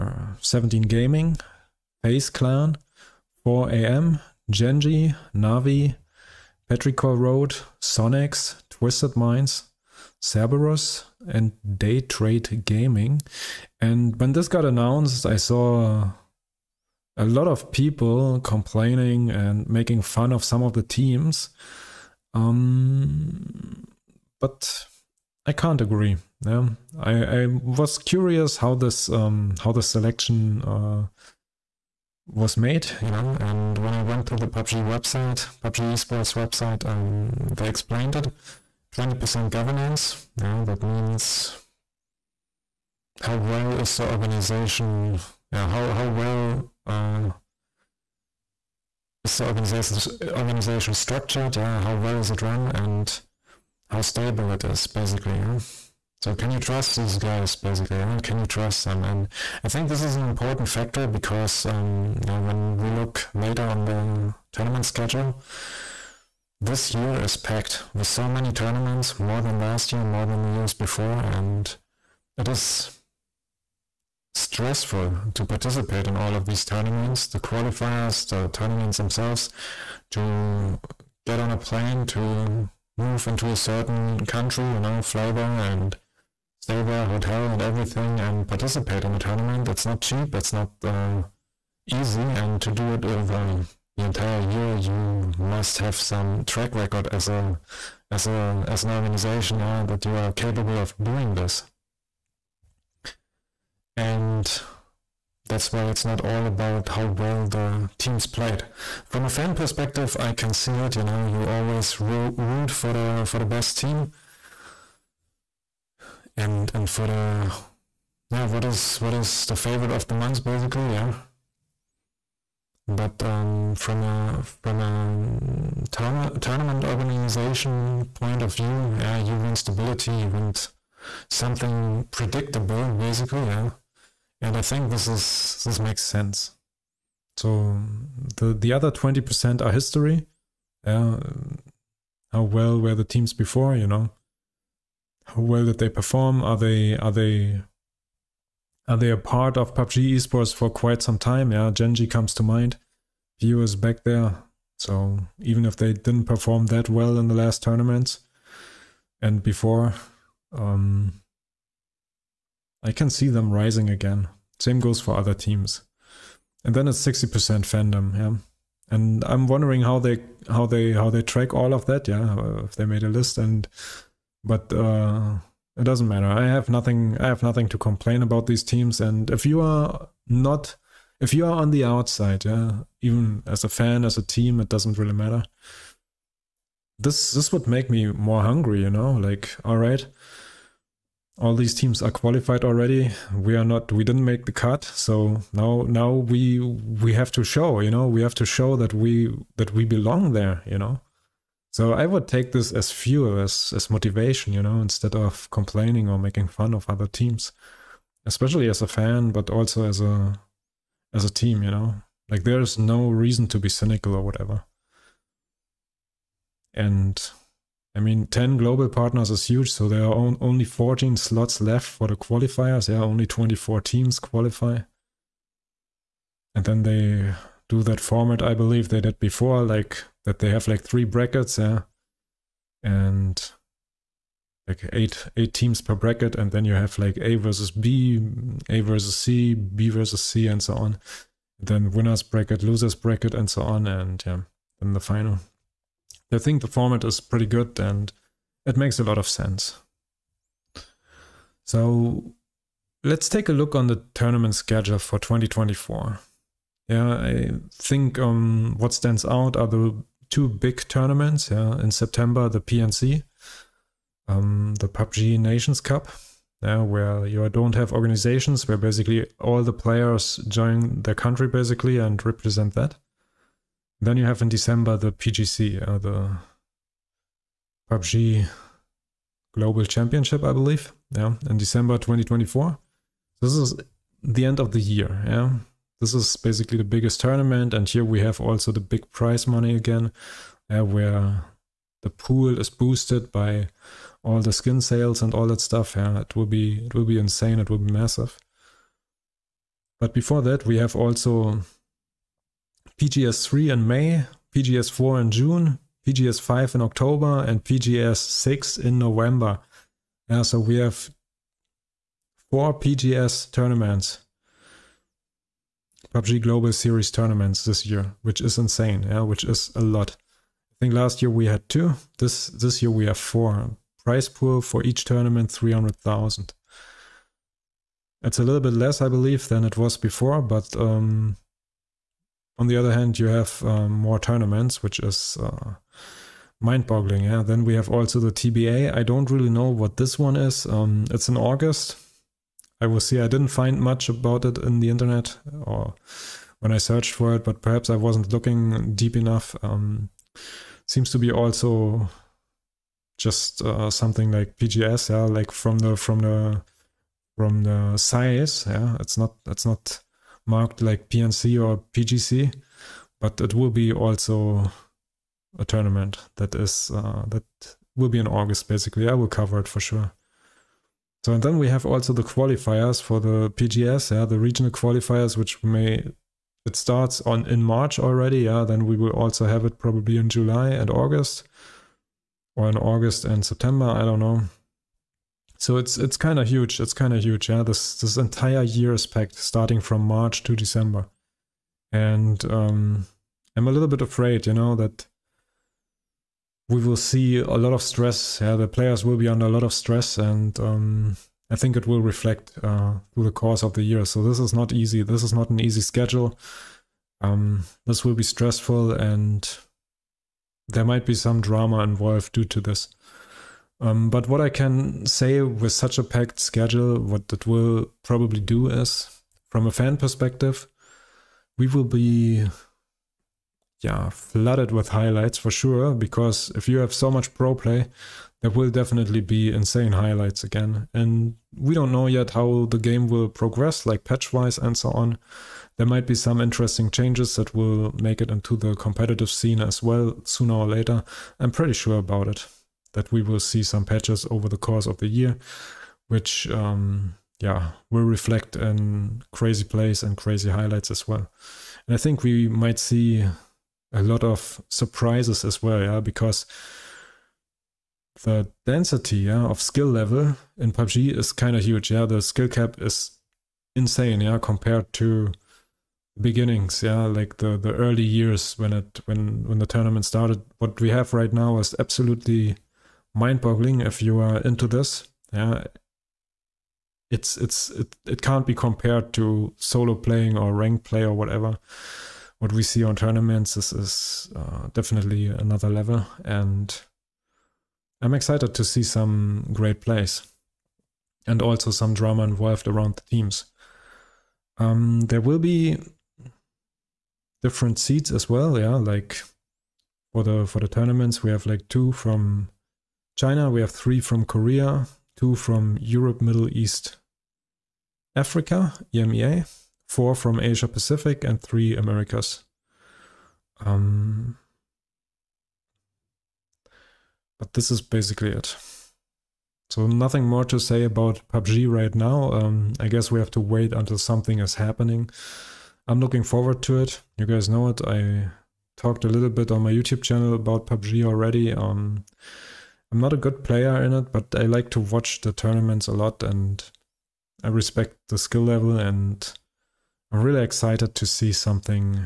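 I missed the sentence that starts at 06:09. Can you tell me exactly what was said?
I will cover it for sure.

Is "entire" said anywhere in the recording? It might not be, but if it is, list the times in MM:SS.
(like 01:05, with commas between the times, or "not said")
01:34, 06:28.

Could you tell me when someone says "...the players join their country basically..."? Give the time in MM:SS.
04:29.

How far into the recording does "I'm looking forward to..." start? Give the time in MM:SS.
08:45.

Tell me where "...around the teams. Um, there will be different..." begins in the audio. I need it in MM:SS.
08:12.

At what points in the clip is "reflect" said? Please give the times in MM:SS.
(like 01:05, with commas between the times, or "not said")
06:42, 07:28.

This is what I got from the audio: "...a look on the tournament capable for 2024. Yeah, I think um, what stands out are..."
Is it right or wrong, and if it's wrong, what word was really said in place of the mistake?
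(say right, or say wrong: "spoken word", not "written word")
wrong: "schedule", not "capable".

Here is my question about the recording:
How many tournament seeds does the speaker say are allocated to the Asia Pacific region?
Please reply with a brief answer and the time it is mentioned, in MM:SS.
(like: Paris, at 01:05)
4, at 08:29.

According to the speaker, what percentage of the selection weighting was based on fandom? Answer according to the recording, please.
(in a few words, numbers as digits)
60%.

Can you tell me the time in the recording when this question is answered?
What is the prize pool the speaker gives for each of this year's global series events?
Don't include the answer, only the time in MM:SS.
05:25.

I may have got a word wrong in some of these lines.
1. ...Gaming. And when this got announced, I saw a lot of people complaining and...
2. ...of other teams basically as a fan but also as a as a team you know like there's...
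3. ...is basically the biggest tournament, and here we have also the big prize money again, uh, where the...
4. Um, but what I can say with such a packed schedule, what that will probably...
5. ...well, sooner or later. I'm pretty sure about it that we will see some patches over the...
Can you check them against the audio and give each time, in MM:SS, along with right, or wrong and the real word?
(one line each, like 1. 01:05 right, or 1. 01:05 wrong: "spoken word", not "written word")
1. 00:12 right
2. 03:26 wrong: "especially", not "basically"
3. 04:46 right
4. 06:53 right
5. 07:19 right.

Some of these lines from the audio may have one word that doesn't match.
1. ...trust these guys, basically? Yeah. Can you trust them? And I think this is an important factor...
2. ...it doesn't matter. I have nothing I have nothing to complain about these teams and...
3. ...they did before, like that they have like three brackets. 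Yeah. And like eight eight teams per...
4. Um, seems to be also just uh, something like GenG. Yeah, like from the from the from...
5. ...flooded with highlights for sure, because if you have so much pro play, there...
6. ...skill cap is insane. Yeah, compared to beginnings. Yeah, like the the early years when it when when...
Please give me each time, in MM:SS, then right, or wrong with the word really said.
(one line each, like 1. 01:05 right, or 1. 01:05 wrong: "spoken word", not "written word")
1. 00:56 right
2. 02:55 right
3. 03:48 right
4. 05:49 wrong: "PGS", not "GenG"
5. 07:04 right
6. 07:42 right.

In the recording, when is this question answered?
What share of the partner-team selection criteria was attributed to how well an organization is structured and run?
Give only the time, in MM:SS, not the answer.
00:38.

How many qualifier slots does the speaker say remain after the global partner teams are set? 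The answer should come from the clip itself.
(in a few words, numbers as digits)
14.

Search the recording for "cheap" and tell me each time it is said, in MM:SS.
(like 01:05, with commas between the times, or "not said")
01:30.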